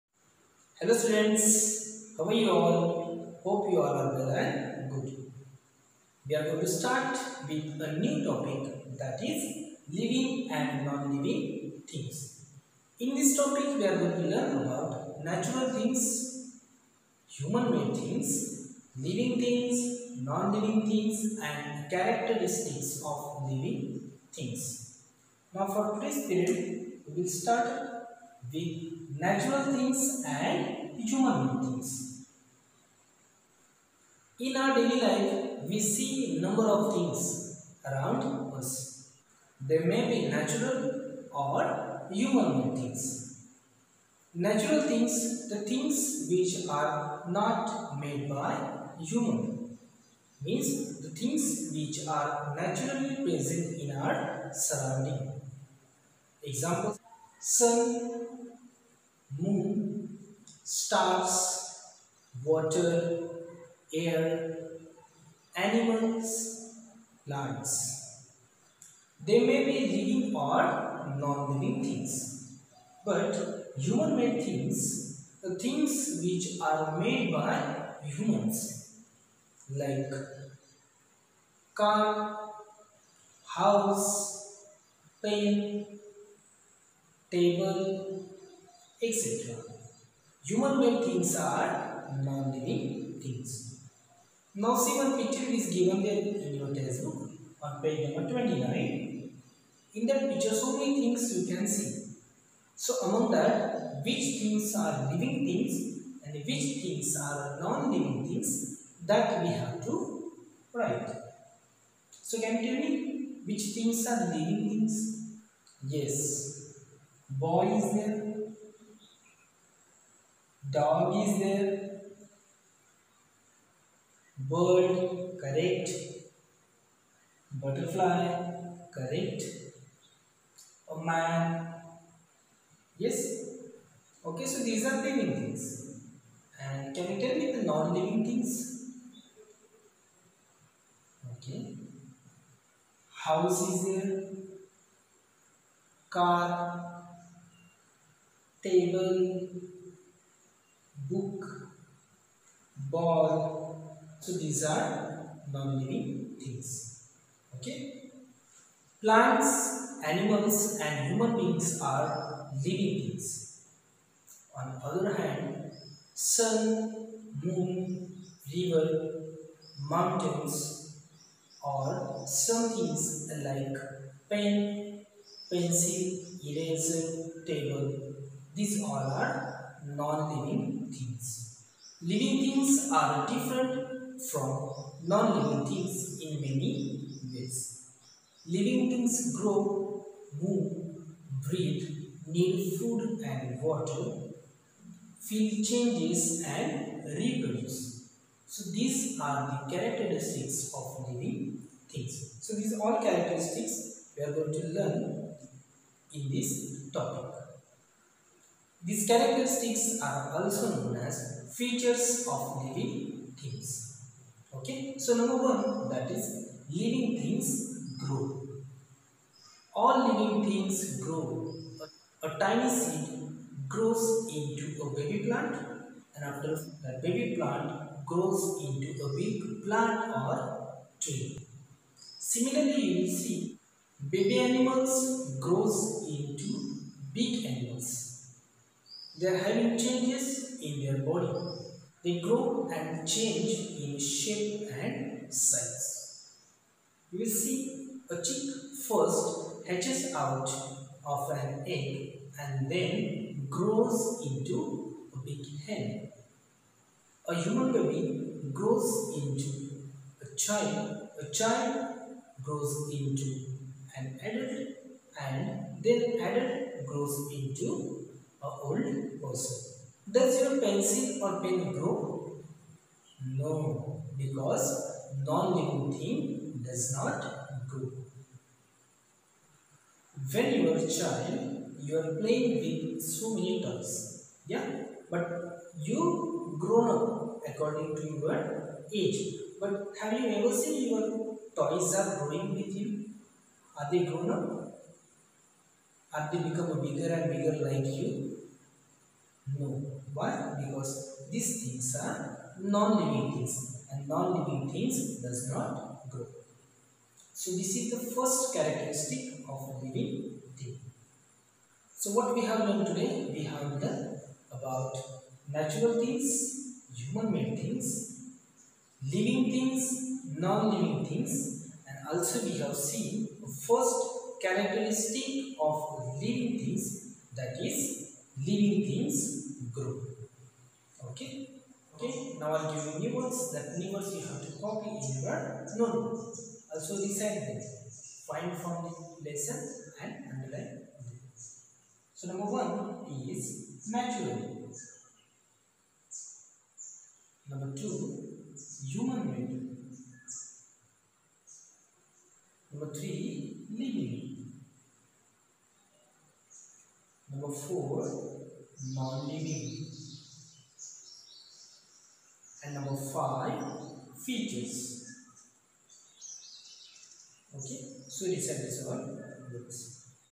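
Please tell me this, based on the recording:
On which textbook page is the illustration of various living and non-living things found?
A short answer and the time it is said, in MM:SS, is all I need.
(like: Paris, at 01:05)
29, at 01:37.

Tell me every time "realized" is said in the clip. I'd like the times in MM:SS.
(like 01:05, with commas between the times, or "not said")
not said.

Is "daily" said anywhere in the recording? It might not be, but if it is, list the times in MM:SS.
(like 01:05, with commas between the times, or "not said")
00:34.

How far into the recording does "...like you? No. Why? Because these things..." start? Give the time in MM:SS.
04:57.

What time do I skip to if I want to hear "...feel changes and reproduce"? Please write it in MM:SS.
03:15.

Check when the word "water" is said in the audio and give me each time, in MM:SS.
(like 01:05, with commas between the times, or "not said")
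01:02, 03:13.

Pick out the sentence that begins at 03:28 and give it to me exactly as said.
These characteristics are also known as features of living things.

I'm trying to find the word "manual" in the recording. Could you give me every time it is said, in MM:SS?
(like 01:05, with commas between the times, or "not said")
not said.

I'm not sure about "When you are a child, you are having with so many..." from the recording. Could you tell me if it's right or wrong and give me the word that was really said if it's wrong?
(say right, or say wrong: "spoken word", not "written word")
wrong: "playing", not "having".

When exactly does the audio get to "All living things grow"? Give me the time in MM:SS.
03:39.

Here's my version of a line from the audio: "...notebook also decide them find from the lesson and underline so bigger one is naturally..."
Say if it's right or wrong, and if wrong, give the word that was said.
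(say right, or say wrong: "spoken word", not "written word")
wrong: "number", not "bigger".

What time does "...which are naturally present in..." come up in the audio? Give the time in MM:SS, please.
00:51.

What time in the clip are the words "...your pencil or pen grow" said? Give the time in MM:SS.
04:30.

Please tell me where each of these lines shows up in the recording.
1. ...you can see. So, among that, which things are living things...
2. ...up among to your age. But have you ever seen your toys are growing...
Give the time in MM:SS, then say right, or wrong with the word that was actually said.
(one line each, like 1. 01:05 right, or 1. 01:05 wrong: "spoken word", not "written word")
1. 01:41 right
2. 04:46 wrong: "according", not "among".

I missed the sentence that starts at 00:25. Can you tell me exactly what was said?
Now for today's period we will start with natural things and human beings.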